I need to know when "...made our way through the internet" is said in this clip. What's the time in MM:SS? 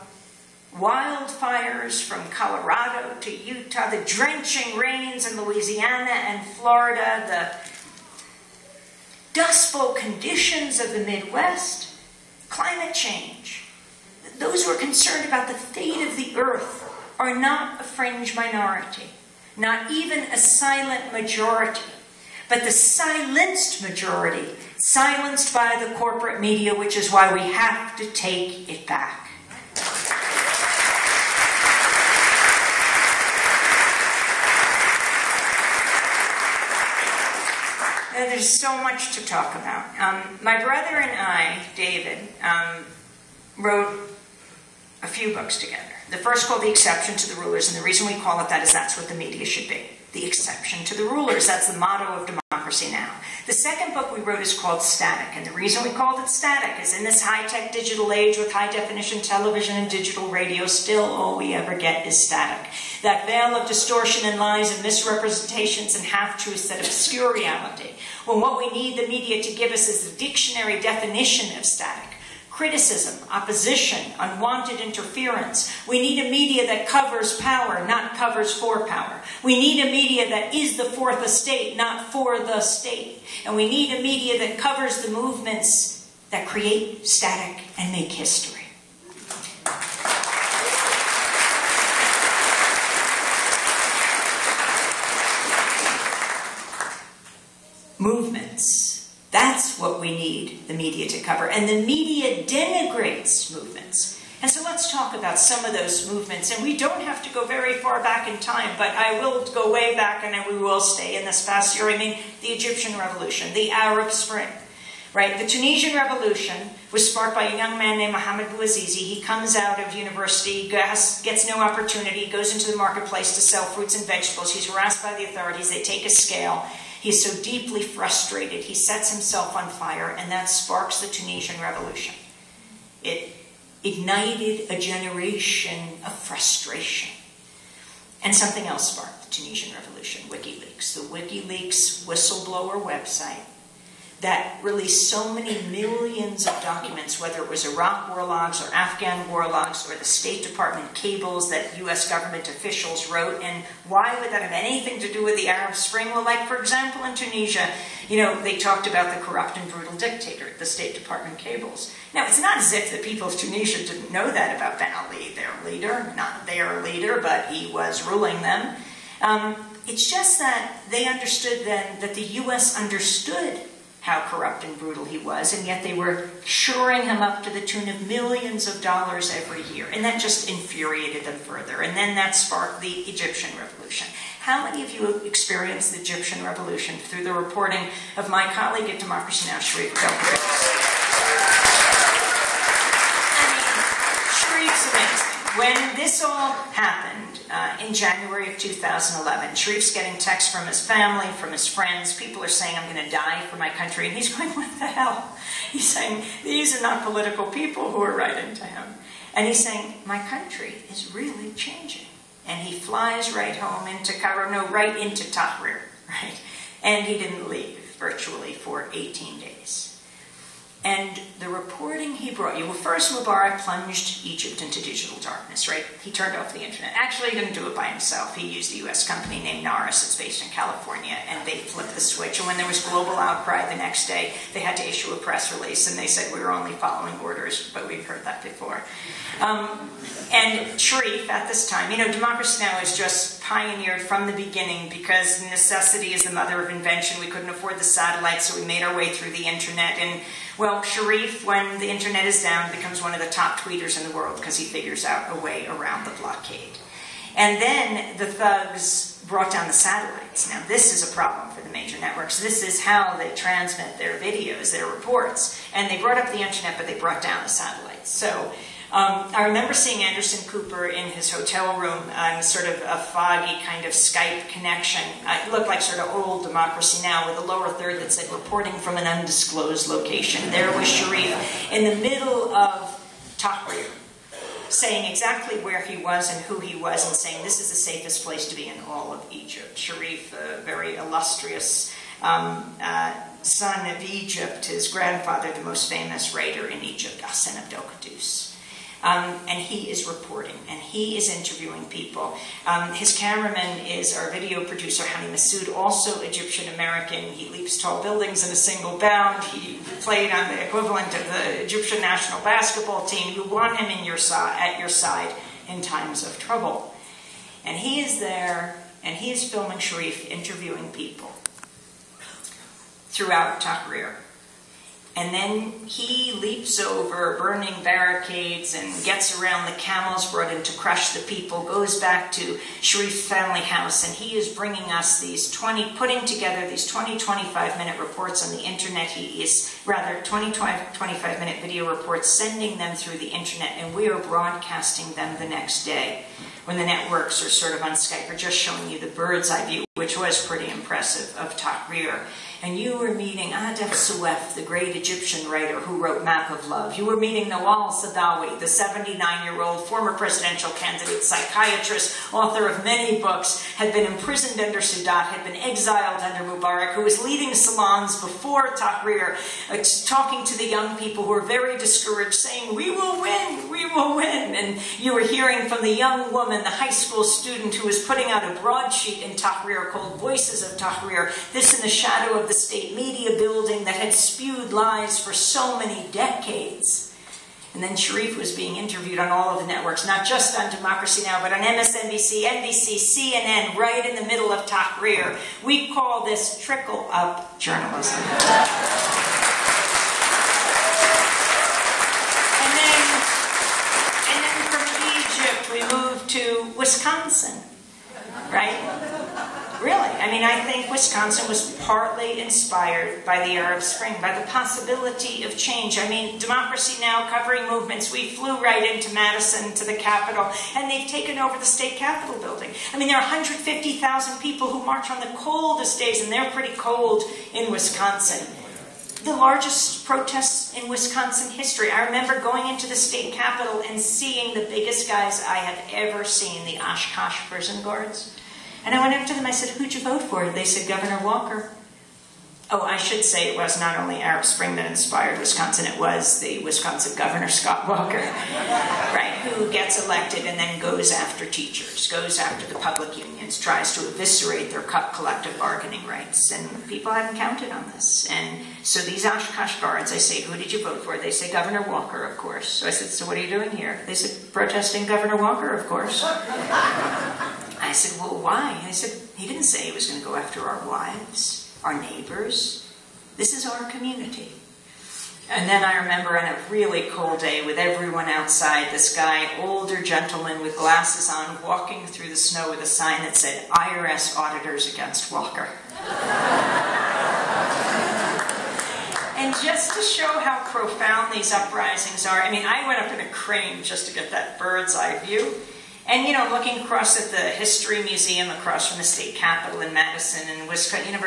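04:08.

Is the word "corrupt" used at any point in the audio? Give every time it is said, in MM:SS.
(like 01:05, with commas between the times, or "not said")
02:39, 02:54.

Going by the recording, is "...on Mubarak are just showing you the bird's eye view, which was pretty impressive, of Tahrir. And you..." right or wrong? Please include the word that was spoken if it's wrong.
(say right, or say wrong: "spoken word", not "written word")
wrong: "Skype", not "Mubarak".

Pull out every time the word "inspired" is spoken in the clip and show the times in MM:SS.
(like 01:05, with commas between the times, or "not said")
06:52, 07:24.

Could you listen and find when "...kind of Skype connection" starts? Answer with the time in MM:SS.
04:33.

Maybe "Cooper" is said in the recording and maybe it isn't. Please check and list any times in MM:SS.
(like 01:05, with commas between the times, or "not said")
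04:30.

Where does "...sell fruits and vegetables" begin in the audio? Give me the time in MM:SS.
02:03.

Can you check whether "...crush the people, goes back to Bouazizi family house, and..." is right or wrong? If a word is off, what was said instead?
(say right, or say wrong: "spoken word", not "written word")
wrong: "Sharif", not "Bouazizi".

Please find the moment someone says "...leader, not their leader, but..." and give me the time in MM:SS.
02:45.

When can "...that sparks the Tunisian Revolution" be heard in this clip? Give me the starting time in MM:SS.
02:10.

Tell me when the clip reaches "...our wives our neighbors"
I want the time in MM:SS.
07:50.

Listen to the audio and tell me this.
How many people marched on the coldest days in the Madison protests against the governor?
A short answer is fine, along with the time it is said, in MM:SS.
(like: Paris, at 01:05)
150,000, at 07:03.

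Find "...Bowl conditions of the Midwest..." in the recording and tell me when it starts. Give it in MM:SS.
00:09.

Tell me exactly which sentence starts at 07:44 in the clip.
They said, protesting Governor Walker, of course.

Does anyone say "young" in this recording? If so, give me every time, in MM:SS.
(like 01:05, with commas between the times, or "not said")
01:57, 06:10, 06:15.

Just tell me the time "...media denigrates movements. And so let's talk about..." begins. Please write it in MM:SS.
01:41.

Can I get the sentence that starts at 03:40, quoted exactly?
And the reporting he brought you, well, first Mubarak plunged Egypt into digital darkness, right?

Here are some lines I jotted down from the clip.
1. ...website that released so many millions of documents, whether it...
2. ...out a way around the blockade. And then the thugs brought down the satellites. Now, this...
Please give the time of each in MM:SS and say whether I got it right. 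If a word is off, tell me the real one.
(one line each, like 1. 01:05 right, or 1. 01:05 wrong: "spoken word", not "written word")
1. 02:22 right
2. 04:15 right.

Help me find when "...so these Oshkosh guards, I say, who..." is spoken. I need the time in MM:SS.
07:38.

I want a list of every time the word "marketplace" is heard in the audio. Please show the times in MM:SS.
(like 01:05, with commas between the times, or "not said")
02:02.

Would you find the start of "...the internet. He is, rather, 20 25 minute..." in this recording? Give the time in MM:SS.
05:38.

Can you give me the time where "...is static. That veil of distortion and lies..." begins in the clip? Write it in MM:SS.
01:02.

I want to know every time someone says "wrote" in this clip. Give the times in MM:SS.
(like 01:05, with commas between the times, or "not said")
00:43, 00:54, 02:33, 05:55.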